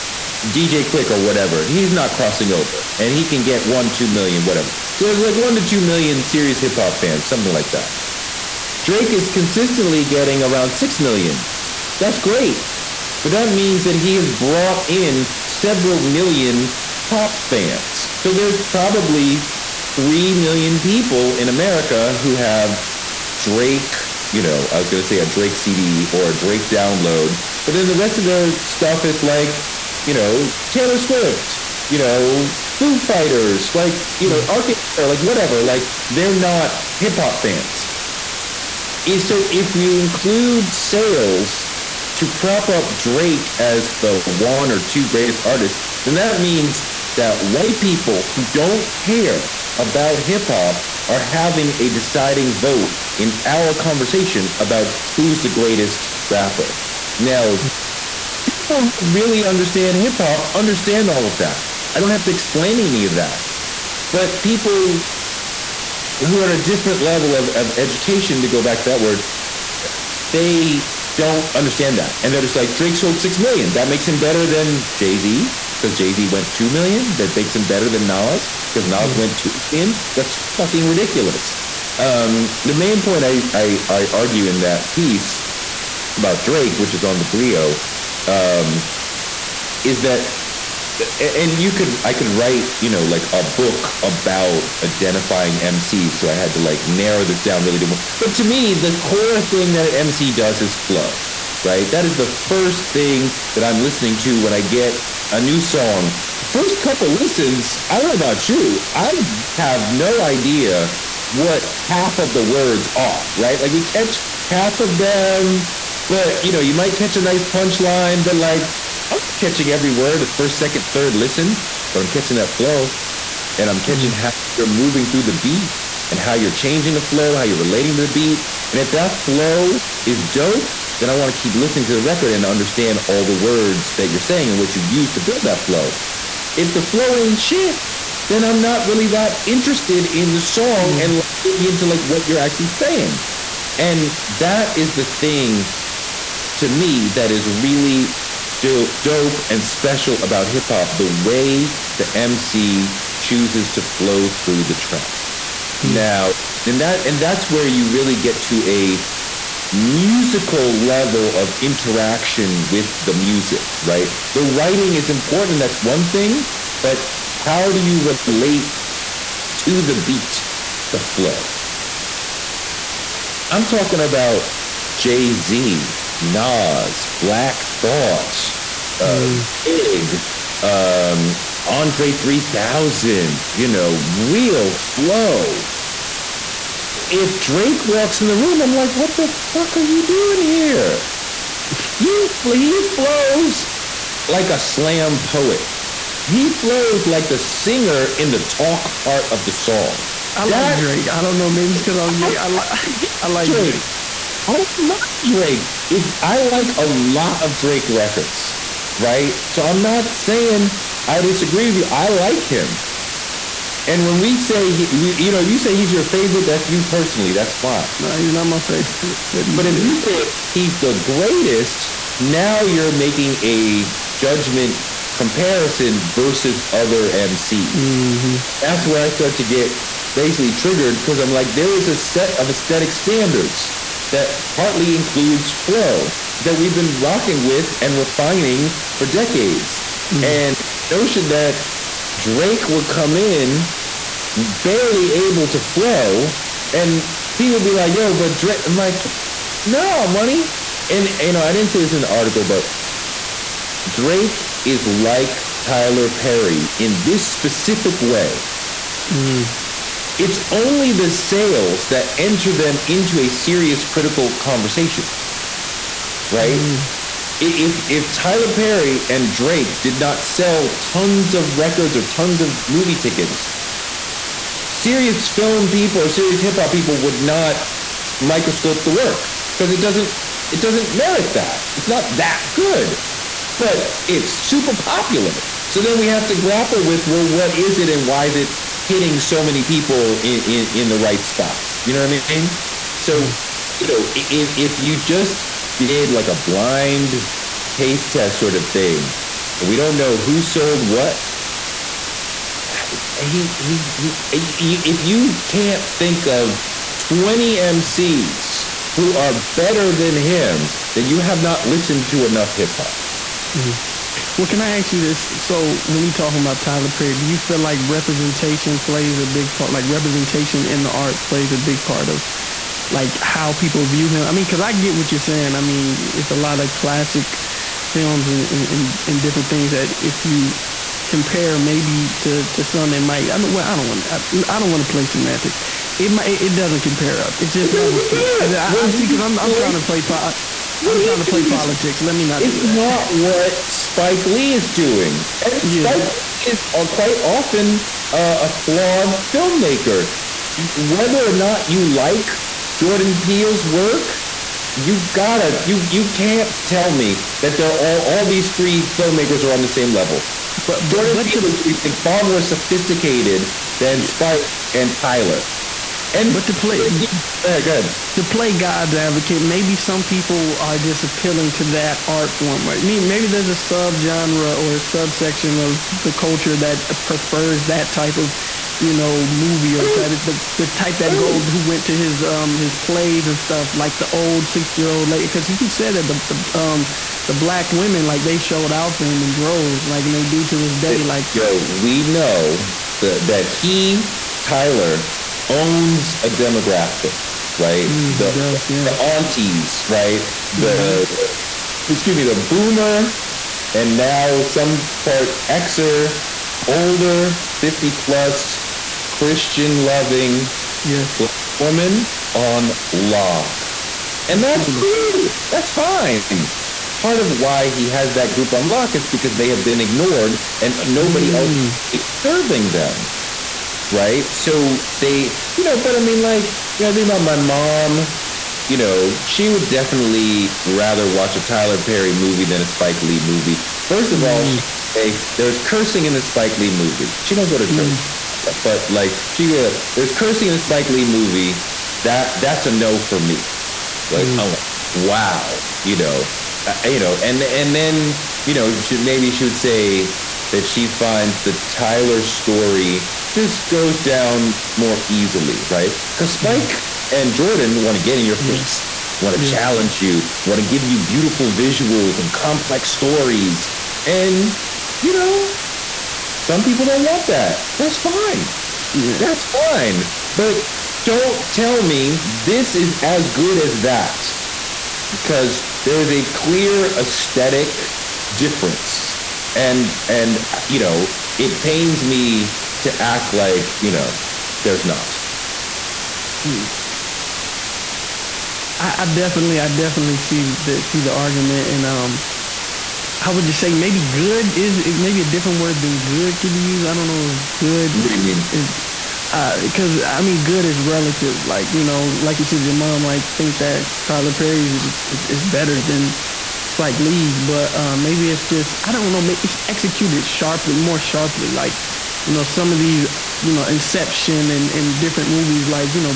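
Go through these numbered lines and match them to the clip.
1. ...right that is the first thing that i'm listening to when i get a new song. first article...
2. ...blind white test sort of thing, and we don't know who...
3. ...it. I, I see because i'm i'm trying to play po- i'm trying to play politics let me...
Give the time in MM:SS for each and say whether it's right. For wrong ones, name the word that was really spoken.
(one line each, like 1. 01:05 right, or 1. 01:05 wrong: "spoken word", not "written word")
1. 01:41 wrong: "couple", not "article"
2. 04:56 wrong: "taste", not "white"
3. 05:38 right.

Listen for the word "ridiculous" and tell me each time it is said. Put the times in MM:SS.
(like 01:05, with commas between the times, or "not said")
01:20.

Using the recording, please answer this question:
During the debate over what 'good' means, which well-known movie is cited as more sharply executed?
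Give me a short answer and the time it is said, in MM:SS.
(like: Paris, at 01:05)
Inception, at 08:33.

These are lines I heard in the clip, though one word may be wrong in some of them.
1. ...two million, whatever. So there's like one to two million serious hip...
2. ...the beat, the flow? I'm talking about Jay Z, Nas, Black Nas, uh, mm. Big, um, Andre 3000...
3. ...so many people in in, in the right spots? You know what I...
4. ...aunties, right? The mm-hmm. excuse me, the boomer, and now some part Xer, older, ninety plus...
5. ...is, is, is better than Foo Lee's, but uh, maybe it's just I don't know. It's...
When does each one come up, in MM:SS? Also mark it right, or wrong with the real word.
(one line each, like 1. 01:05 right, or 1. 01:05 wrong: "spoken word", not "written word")
1. 00:03 right
2. 02:49 wrong: "Thought", not "Nas"
3. 04:49 right
4. 06:38 wrong: "fifty", not "ninety"
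5. 08:24 wrong: "Spike", not "Foo".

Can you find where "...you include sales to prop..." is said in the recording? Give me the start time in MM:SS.
00:39.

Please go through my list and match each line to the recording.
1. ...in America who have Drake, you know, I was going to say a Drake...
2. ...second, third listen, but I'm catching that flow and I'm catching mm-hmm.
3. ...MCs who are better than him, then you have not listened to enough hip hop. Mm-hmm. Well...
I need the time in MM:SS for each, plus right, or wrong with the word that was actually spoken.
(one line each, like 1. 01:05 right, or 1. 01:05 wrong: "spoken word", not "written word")
1. 00:21 right
2. 02:00 right
3. 05:07 right.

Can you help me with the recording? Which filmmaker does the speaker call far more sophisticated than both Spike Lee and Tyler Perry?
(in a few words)
Jordan Peele.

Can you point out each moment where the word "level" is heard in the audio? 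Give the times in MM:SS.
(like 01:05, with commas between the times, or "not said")
01:06, 02:40, 05:37, 05:59.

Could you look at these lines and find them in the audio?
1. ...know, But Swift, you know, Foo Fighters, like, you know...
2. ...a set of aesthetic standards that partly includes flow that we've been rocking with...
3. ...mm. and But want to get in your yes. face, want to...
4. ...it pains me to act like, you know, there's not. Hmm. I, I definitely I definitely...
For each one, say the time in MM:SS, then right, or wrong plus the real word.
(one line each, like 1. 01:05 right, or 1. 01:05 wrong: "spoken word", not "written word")
1. 00:30 wrong: "Taylor", not "But"
2. 03:51 right
3. 07:36 wrong: "Jordan", not "But"
4. 08:01 right.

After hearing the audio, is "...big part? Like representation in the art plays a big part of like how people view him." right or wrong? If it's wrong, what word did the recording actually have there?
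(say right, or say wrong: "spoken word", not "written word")
right.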